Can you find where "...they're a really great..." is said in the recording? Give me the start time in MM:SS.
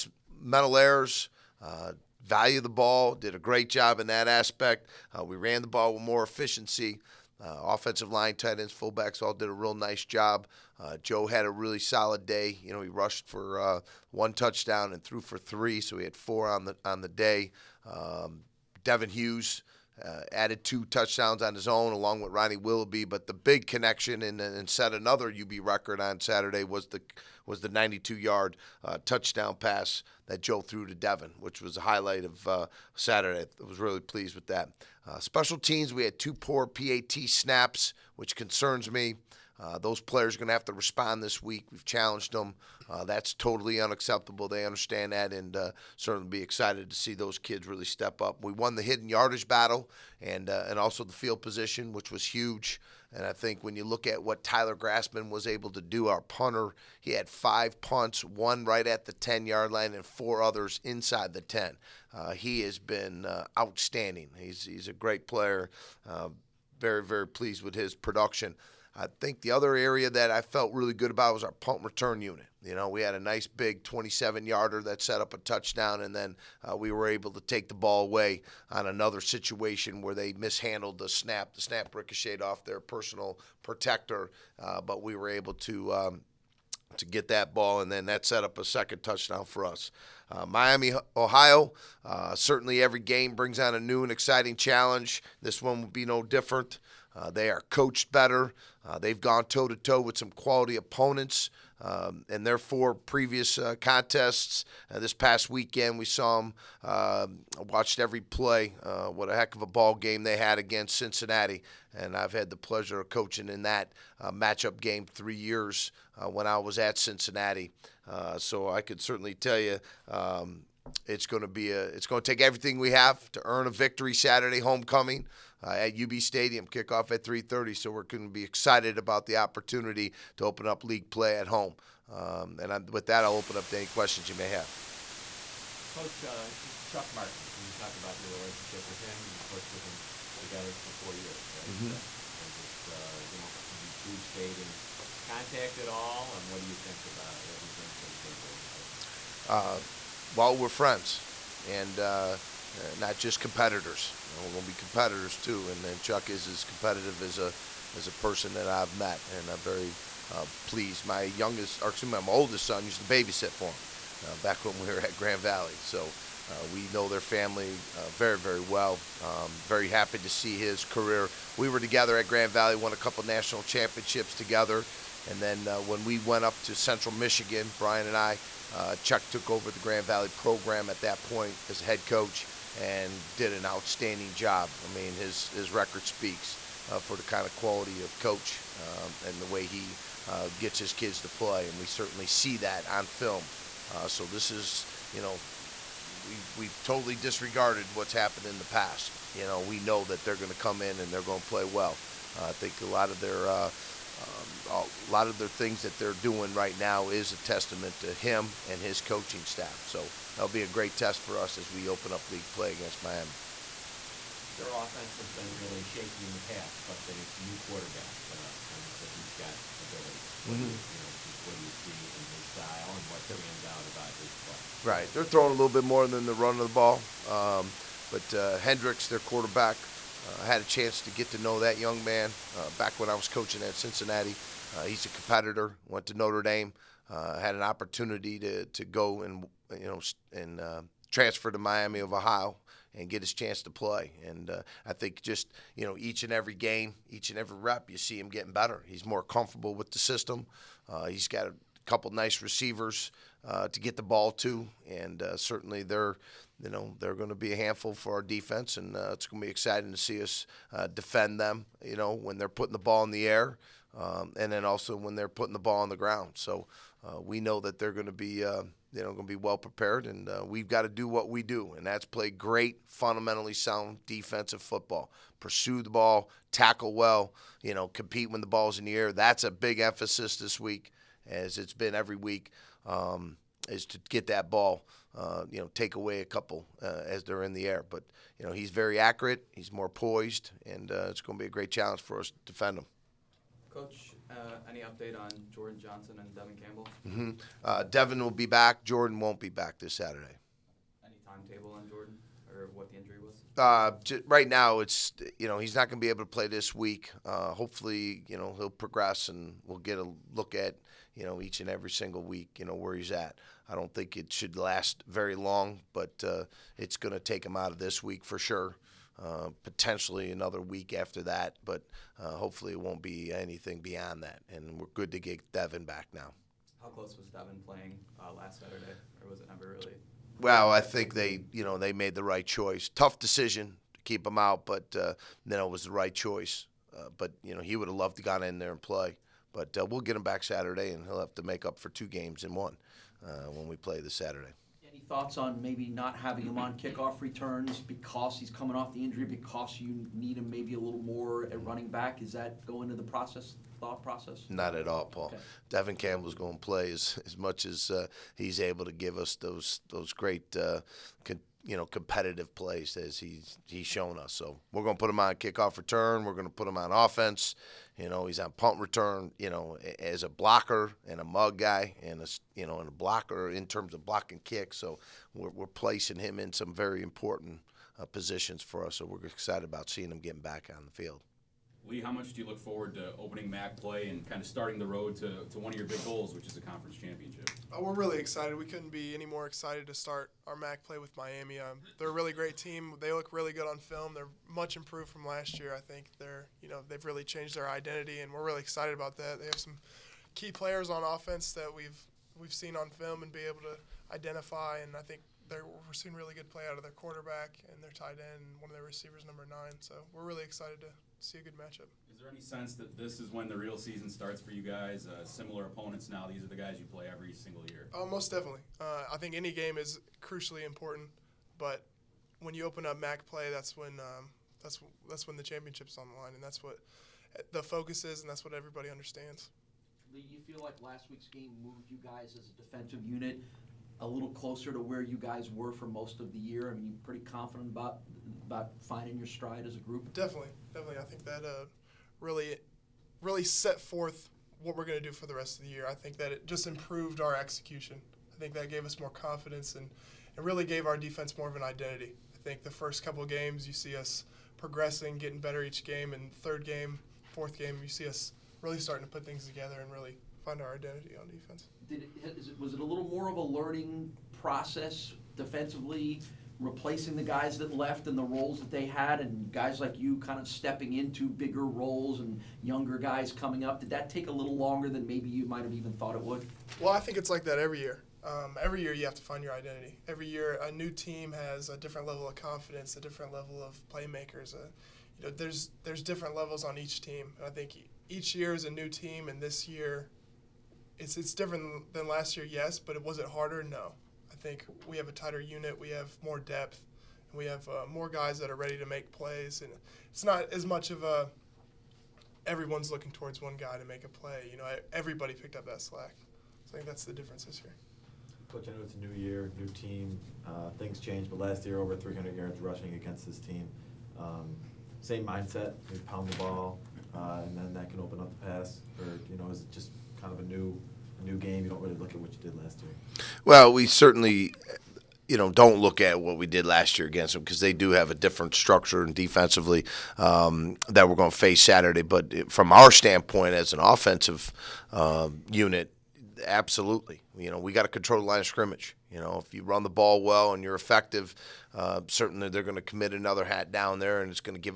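06:31.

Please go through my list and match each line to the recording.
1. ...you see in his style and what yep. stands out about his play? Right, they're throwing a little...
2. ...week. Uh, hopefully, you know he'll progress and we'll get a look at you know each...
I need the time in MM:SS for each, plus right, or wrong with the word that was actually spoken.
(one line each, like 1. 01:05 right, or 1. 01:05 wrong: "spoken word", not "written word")
1. 03:41 right
2. 05:06 right.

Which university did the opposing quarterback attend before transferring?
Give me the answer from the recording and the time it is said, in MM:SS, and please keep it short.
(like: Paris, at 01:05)
Notre Dame, at 03:56.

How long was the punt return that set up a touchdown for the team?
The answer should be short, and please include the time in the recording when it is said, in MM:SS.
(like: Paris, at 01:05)
27 yards, at 01:13.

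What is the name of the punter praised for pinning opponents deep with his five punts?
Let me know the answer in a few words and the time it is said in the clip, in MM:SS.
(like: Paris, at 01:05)
Tyler Grassman, at 00:54.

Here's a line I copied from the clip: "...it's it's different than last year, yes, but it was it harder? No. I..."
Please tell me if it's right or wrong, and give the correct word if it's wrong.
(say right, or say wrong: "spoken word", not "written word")
right.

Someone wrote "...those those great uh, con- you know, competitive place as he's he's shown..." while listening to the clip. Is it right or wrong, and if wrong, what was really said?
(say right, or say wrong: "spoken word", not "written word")
right.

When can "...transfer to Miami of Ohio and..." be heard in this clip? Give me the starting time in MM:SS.
04:01.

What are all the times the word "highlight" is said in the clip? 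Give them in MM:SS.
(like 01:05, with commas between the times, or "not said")
00:31.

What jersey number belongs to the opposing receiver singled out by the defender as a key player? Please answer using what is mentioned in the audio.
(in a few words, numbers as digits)
9.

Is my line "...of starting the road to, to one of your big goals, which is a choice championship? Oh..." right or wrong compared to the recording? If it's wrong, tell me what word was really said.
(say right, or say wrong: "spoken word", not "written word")
wrong: "conference", not "choice".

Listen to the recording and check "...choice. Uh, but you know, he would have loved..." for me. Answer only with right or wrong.
right.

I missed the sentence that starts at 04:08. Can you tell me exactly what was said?
He's more comfortable with the system.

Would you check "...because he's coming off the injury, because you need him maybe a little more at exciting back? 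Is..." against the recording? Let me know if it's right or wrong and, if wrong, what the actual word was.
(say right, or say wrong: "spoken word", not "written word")
wrong: "running", not "exciting".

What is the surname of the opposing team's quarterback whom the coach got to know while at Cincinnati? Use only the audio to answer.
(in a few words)
Hendrix.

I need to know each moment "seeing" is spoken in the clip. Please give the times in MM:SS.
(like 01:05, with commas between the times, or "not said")
06:19, 06:45.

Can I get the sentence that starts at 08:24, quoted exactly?
You know, everybody picked up that slack.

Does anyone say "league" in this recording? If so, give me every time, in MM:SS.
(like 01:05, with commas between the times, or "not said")
02:10, 03:32.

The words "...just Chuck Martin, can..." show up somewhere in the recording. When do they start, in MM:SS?
02:16.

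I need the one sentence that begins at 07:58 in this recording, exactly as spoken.
Um, every year you have to find your identity.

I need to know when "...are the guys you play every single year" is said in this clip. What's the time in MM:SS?
06:56.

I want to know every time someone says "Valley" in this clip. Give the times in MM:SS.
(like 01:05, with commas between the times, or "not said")
02:45, 02:52, 03:00.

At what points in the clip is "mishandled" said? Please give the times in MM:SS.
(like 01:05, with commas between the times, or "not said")
01:20.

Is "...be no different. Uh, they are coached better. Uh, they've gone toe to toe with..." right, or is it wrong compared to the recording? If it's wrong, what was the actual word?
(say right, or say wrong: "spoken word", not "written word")
right.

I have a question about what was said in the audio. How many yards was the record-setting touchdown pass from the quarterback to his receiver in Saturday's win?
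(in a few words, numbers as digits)
92.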